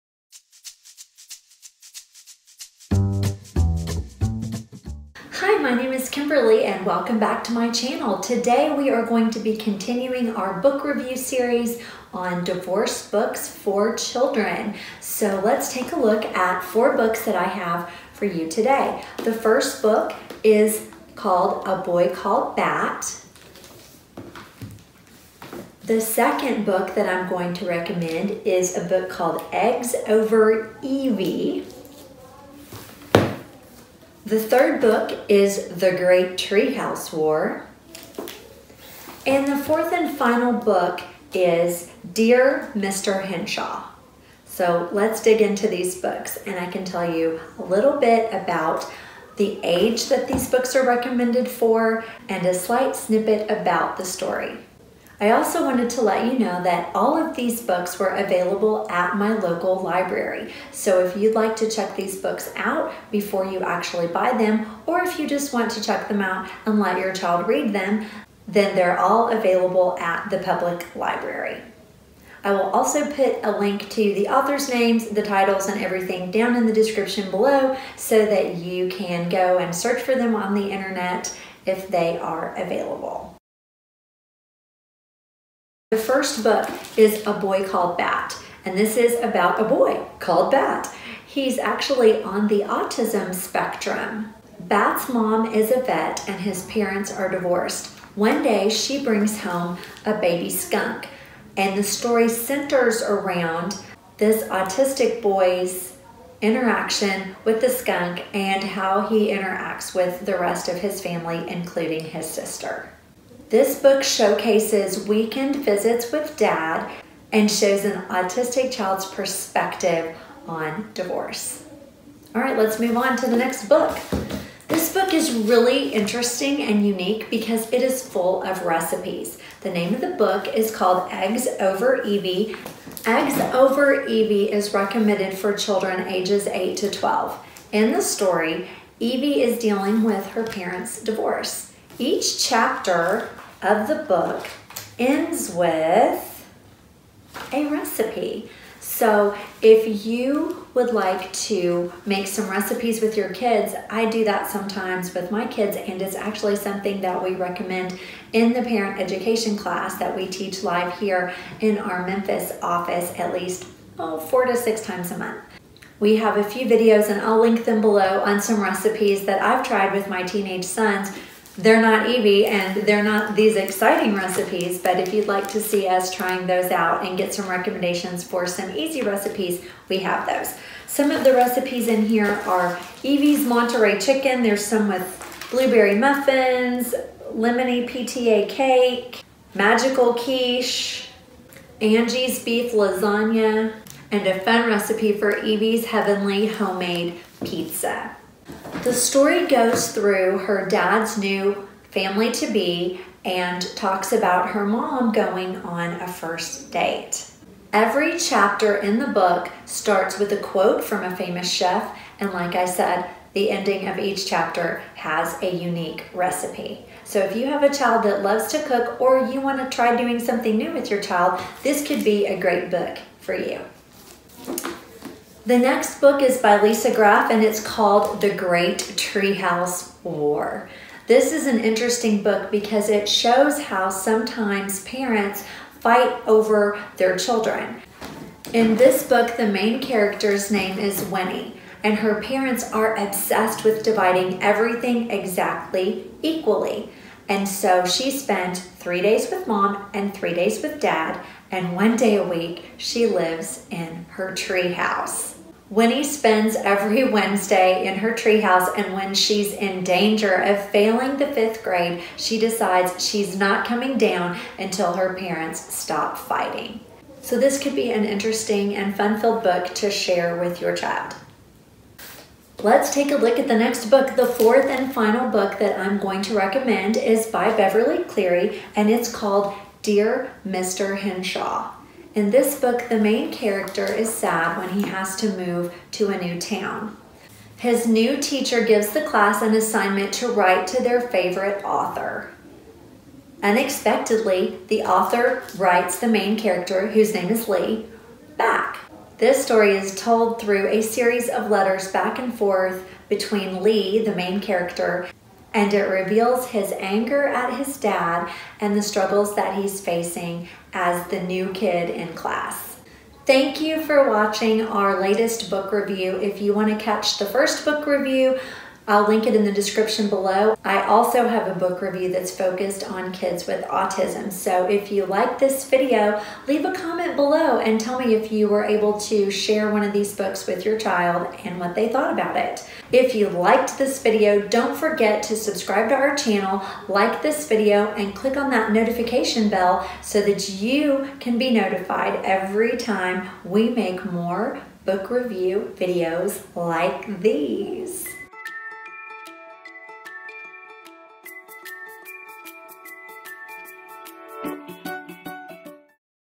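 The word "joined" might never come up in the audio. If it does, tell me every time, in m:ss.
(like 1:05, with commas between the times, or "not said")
not said.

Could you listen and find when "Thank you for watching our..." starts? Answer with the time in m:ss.
5:13.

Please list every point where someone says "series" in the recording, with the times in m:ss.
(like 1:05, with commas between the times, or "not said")
0:11, 5:00.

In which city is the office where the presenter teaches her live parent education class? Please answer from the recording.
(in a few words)
Memphis.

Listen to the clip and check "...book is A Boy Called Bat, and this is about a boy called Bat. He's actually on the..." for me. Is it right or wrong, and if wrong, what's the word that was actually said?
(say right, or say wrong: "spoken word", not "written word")
right.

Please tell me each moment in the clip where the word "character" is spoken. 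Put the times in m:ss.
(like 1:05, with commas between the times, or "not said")
3:59, 4:43, 4:56, 5:04.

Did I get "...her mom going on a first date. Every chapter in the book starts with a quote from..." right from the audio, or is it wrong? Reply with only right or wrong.
right.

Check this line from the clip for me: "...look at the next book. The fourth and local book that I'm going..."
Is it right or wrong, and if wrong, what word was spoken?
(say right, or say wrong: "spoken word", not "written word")
wrong: "final", not "local".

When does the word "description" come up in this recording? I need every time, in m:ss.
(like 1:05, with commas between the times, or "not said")
1:16, 5:19.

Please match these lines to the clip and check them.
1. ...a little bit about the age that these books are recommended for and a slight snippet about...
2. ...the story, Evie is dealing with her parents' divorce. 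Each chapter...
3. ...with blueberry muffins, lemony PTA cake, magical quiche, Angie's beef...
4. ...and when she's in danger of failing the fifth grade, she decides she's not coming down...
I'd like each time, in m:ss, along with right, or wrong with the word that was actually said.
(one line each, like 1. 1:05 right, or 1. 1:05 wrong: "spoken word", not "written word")
1. 0:47 right
2. 2:17 right
3. 3:04 right
4. 4:18 right.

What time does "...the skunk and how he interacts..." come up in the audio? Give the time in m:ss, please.
1:47.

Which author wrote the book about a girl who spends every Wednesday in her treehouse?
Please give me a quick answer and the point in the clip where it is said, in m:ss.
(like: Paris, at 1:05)
Lisa Graff, at 3:46.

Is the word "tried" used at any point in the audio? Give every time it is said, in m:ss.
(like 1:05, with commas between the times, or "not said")
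2:49.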